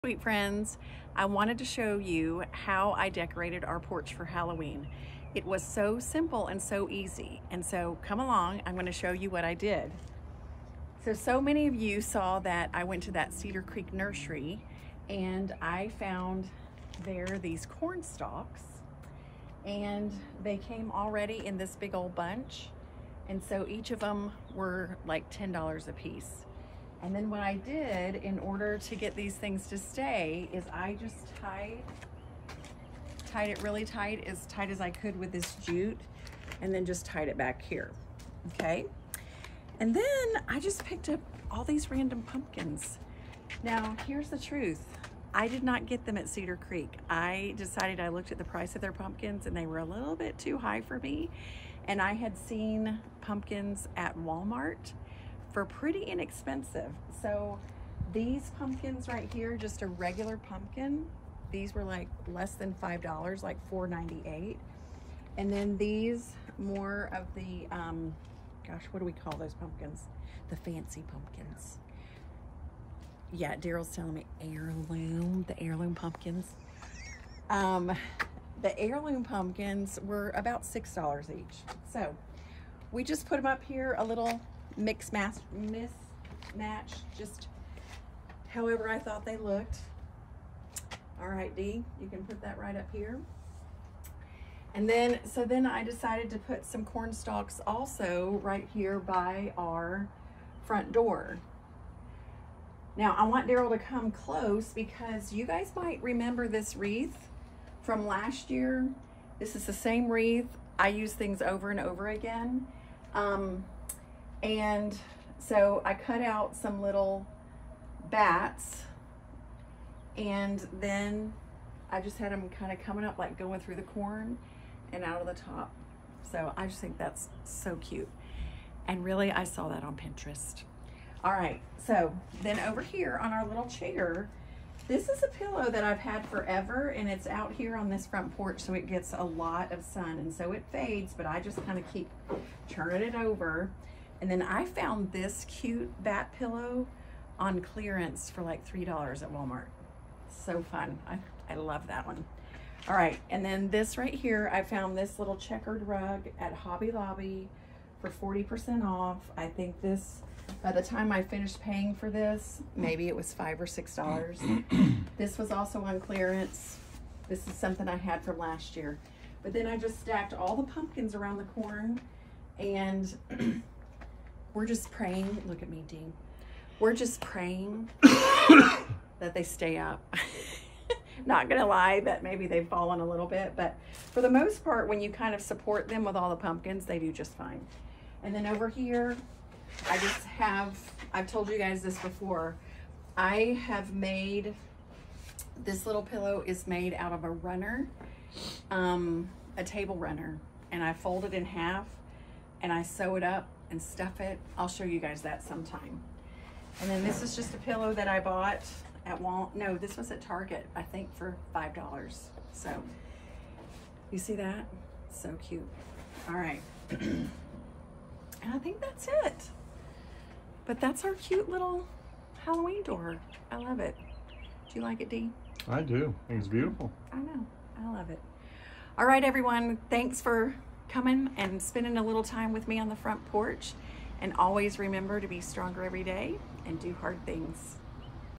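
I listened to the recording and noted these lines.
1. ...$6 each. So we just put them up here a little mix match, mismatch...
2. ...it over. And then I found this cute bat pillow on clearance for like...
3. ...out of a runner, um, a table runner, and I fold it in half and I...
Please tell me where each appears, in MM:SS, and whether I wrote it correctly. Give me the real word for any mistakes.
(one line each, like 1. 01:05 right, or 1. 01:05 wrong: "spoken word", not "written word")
1. 01:20 right
2. 02:23 right
3. 03:16 right.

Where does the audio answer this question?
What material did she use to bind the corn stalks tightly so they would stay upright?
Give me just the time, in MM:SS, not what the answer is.
00:35.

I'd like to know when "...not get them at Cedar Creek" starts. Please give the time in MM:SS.
00:45.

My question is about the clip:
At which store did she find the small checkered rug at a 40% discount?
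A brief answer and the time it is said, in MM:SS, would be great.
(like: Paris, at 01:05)
Hobby Lobby, at 02:36.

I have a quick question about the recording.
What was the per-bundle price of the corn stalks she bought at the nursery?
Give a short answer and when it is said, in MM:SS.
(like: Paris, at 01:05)
$10, at 00:25.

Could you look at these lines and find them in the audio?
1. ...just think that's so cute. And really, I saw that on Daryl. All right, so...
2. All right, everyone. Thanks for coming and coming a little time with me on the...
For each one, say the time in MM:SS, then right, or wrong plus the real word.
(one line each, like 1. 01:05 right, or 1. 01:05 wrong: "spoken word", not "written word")
1. 02:06 wrong: "Pinterest", not "Daryl"
2. 03:48 wrong: "spending", not "coming".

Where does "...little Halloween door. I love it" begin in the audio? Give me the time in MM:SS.
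03:41.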